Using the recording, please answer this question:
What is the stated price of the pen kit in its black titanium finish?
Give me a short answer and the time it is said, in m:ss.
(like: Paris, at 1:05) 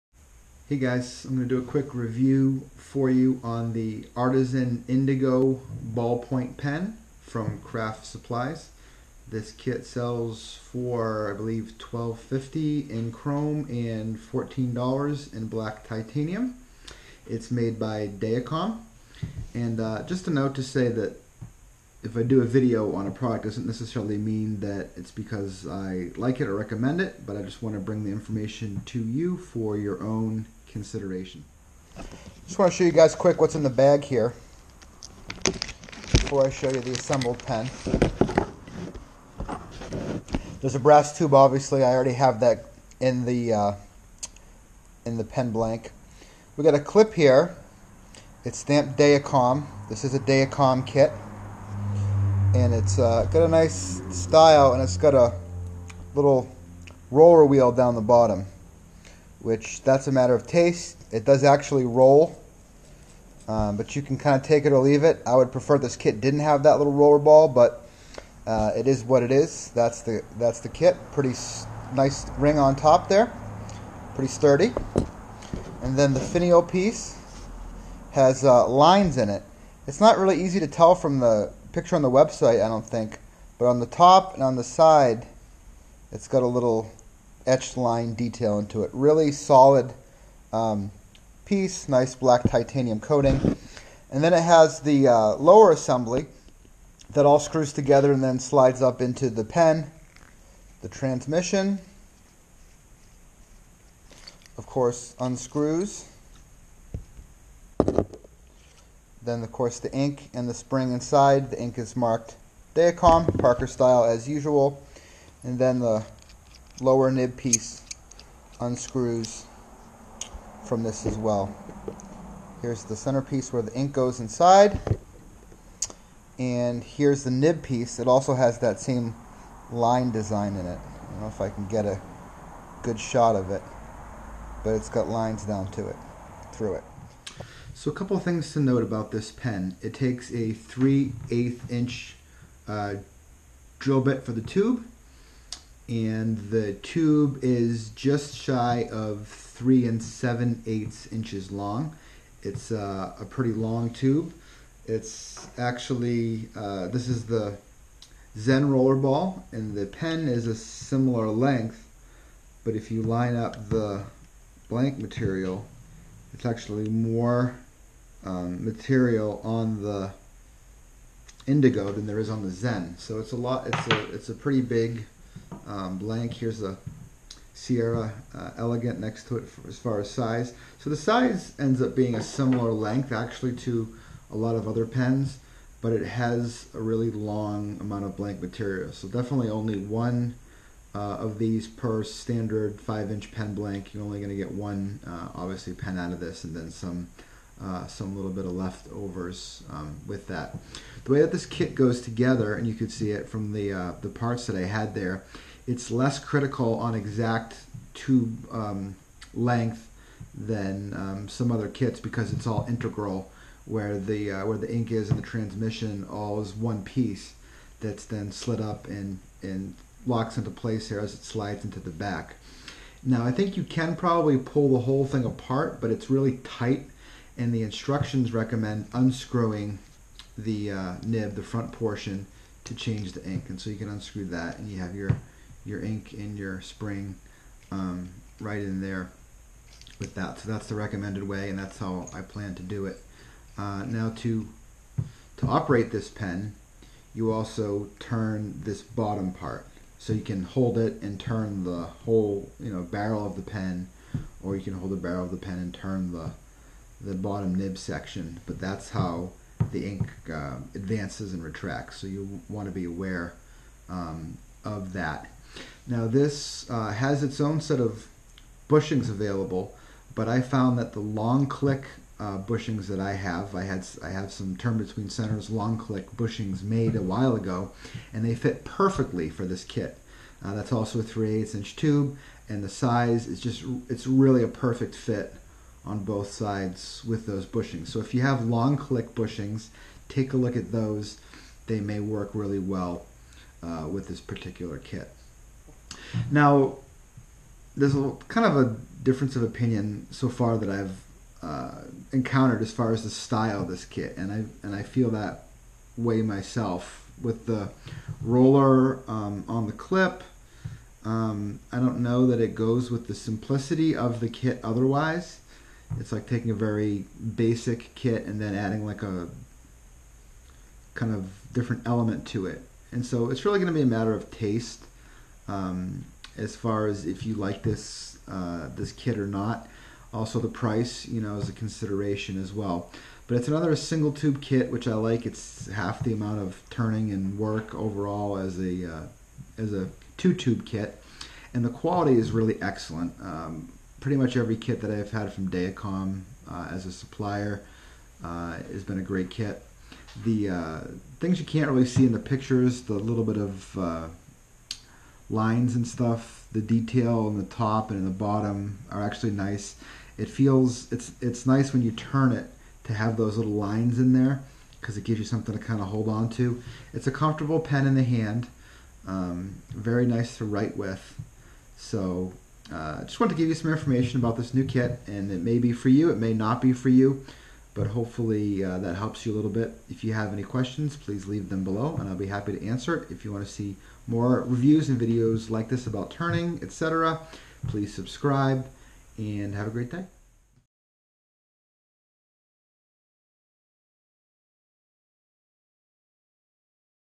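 $14, at 0:14.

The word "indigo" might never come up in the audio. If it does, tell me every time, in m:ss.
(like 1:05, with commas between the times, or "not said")
0:04, 2:51.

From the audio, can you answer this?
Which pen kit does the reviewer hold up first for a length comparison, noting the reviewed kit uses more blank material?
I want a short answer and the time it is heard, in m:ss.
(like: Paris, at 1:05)
Zen rollerball, at 2:38.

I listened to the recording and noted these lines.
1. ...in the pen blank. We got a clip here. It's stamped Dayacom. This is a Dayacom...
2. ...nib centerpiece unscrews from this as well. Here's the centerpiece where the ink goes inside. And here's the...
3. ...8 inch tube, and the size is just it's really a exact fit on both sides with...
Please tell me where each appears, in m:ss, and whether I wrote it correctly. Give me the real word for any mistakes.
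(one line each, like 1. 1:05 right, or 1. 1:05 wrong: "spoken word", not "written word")
1. 0:45 right
2. 1:57 wrong: "piece", not "centerpiece"
3. 4:41 wrong: "perfect", not "exact".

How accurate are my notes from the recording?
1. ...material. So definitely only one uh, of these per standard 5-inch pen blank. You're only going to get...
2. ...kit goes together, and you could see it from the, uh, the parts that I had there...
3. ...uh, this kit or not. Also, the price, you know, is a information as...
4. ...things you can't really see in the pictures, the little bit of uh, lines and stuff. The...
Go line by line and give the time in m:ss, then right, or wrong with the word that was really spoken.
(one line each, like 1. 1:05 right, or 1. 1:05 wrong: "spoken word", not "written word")
1. 3:08 right
2. 3:21 right
3. 5:28 wrong: "consideration", not "information"
4. 5:51 right.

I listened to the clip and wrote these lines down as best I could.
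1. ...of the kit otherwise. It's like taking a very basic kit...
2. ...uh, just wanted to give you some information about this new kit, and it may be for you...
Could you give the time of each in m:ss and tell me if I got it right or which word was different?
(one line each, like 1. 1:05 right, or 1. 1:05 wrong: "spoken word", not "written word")
1. 5:13 right
2. 6:12 right.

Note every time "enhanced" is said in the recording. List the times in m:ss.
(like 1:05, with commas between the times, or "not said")
not said.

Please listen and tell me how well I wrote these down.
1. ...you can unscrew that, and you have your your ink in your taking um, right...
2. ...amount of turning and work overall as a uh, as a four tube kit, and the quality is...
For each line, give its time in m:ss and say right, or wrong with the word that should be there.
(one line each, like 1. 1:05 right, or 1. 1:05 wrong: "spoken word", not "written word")
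1. 3:53 wrong: "spring", not "taking"
2. 5:36 wrong: "two", not "four".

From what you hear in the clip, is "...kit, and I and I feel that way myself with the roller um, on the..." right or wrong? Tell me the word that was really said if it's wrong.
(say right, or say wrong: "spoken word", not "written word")
right.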